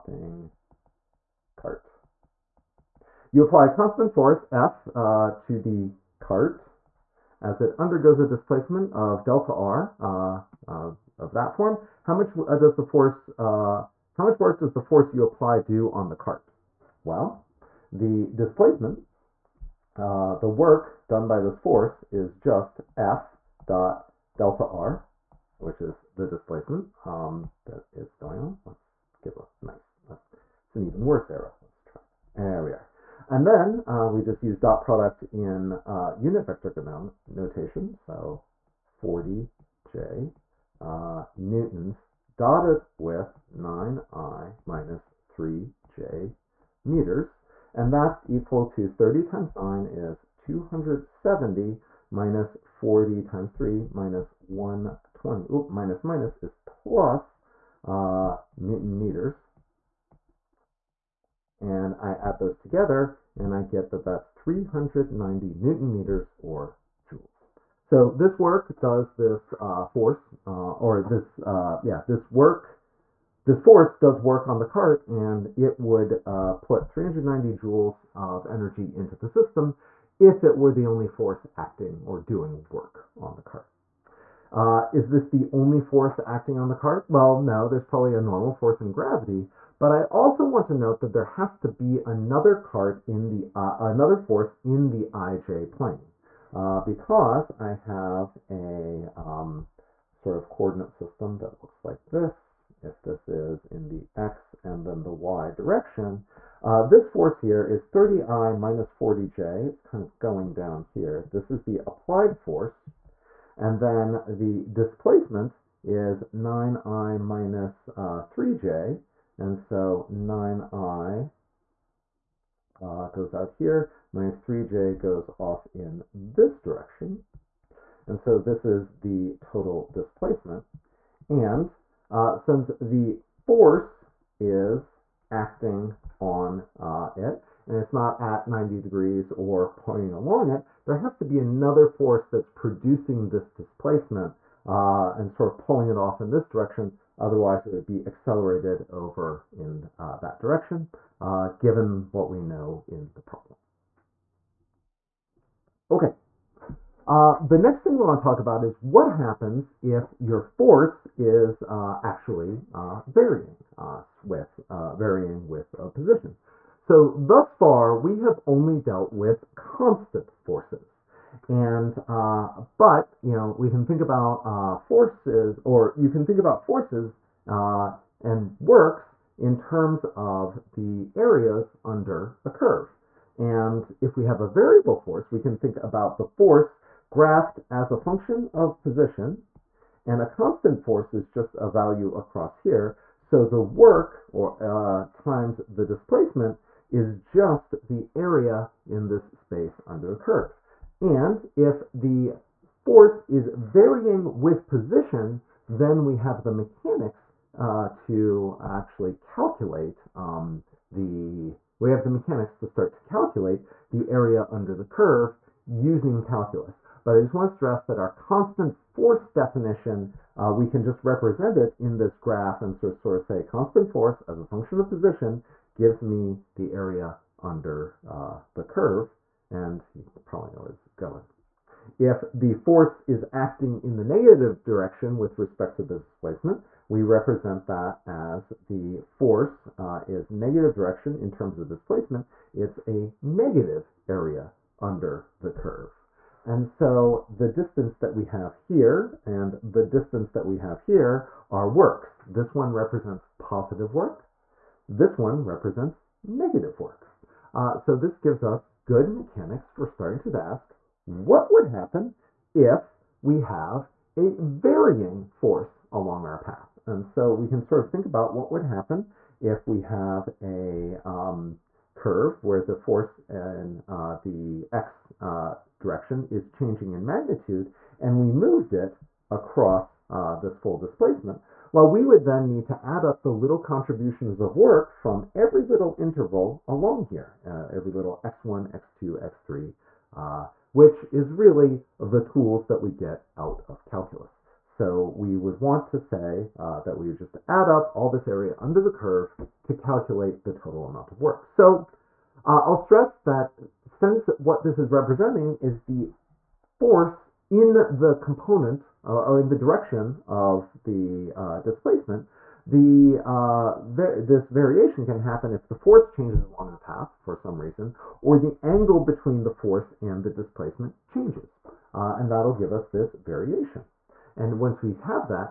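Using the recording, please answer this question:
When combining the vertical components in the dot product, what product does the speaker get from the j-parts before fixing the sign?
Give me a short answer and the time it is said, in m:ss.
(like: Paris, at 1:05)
120, at 0:53.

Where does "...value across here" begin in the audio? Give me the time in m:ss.
3:11.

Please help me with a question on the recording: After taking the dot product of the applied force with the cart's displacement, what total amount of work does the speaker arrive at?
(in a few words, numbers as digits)
390 joules.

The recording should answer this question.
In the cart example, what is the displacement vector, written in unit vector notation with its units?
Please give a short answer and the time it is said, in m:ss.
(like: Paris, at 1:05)
9i minus 3j meters, at 0:43.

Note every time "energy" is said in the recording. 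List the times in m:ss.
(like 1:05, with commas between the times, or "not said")
1:18.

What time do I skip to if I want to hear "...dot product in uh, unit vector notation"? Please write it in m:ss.
0:34.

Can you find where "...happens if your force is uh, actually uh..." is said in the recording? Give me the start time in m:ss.
2:39.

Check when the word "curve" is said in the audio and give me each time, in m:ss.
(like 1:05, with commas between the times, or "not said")
3:02, 3:20, 3:34, 3:48, 4:05, 4:31, 4:58.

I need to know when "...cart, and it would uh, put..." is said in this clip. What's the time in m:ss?
1:14.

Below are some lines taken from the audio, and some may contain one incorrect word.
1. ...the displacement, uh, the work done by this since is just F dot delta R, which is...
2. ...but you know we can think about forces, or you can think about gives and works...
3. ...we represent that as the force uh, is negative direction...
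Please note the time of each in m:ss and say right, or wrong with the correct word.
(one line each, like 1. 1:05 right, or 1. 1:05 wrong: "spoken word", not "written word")
1. 0:17 wrong: "force", not "since"
2. 2:52 wrong: "forces", not "gives"
3. 3:56 right.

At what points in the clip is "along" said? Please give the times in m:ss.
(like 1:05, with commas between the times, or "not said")
2:20, 4:25, 4:46, 5:16.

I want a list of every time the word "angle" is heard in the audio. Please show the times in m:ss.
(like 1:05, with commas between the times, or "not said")
5:18.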